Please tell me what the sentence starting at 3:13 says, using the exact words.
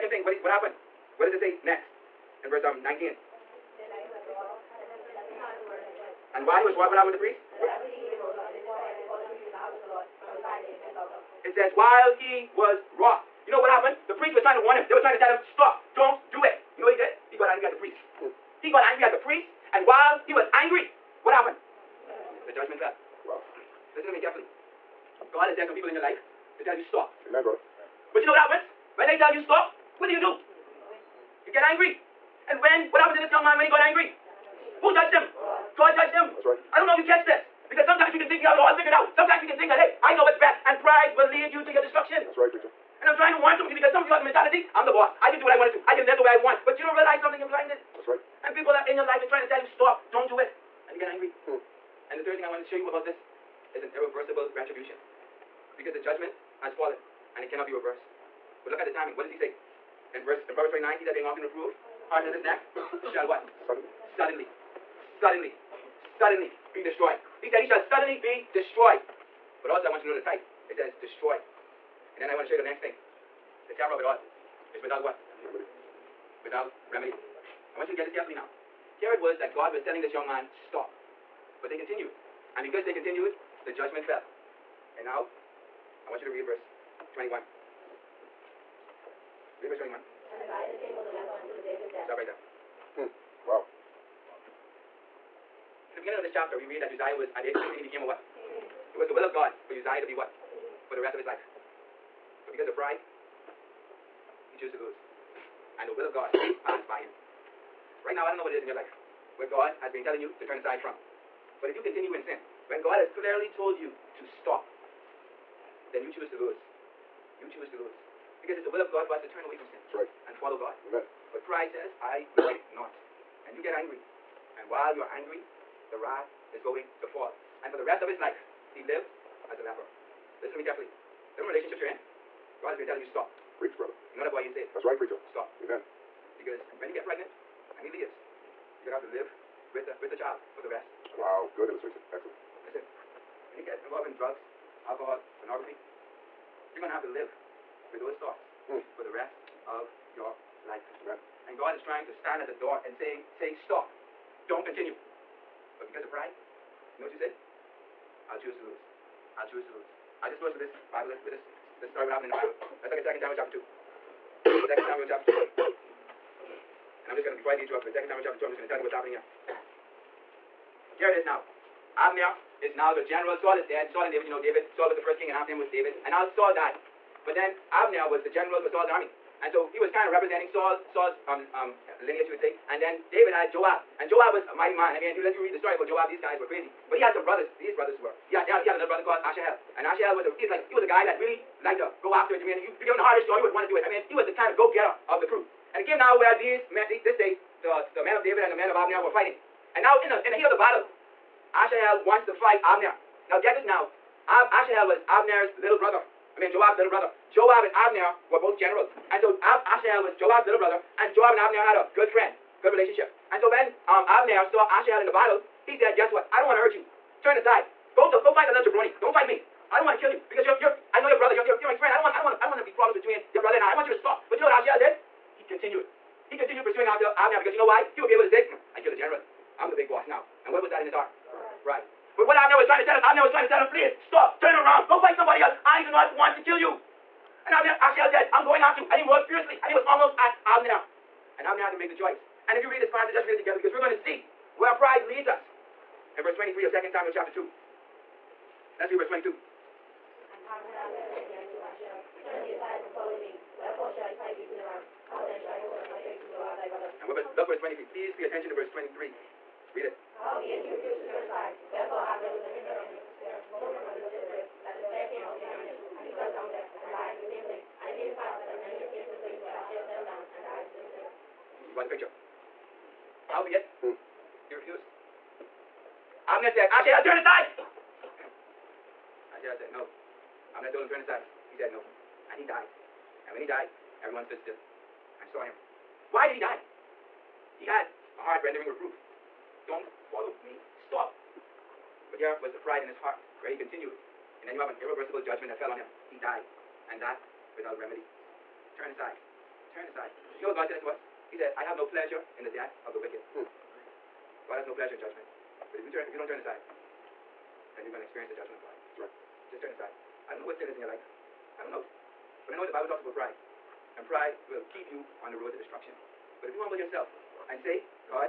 I mean, he was the kind of go-getter of the crew.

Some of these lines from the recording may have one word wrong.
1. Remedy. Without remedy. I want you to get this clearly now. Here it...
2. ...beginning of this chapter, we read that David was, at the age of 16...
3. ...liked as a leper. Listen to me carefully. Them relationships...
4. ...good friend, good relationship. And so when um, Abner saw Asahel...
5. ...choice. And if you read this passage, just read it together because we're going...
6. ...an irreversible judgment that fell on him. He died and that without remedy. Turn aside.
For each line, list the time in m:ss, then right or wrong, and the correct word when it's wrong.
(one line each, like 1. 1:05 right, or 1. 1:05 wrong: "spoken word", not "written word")
1. 1:15 wrong: "carefully", not "clearly"
2. 1:35 wrong: "Uzziah", not "David"
3. 2:08 wrong: "lived", not "liked"
4. 3:31 right
5. 4:01 right
6. 4:54 right.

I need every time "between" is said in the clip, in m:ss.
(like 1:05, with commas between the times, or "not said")
3:42.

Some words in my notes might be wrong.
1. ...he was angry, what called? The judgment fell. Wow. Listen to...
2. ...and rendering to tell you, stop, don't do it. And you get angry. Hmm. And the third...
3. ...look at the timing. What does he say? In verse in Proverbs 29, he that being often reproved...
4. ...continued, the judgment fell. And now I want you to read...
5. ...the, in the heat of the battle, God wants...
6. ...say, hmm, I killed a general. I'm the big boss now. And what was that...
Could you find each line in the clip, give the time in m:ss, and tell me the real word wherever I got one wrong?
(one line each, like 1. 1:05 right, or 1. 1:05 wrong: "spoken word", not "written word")
1. 0:20 wrong: "happened", not "called"
2. 0:49 wrong: "trying", not "rendering"
3. 0:58 right
4. 1:22 right
5. 3:20 wrong: "Asahel", not "God"
6. 3:48 right.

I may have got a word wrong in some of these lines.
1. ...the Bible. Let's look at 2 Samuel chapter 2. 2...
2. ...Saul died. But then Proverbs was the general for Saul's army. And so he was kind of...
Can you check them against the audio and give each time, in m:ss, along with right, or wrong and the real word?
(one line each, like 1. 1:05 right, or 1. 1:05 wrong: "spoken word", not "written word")
1. 2:42 right
2. 2:56 wrong: "Abner", not "Proverbs".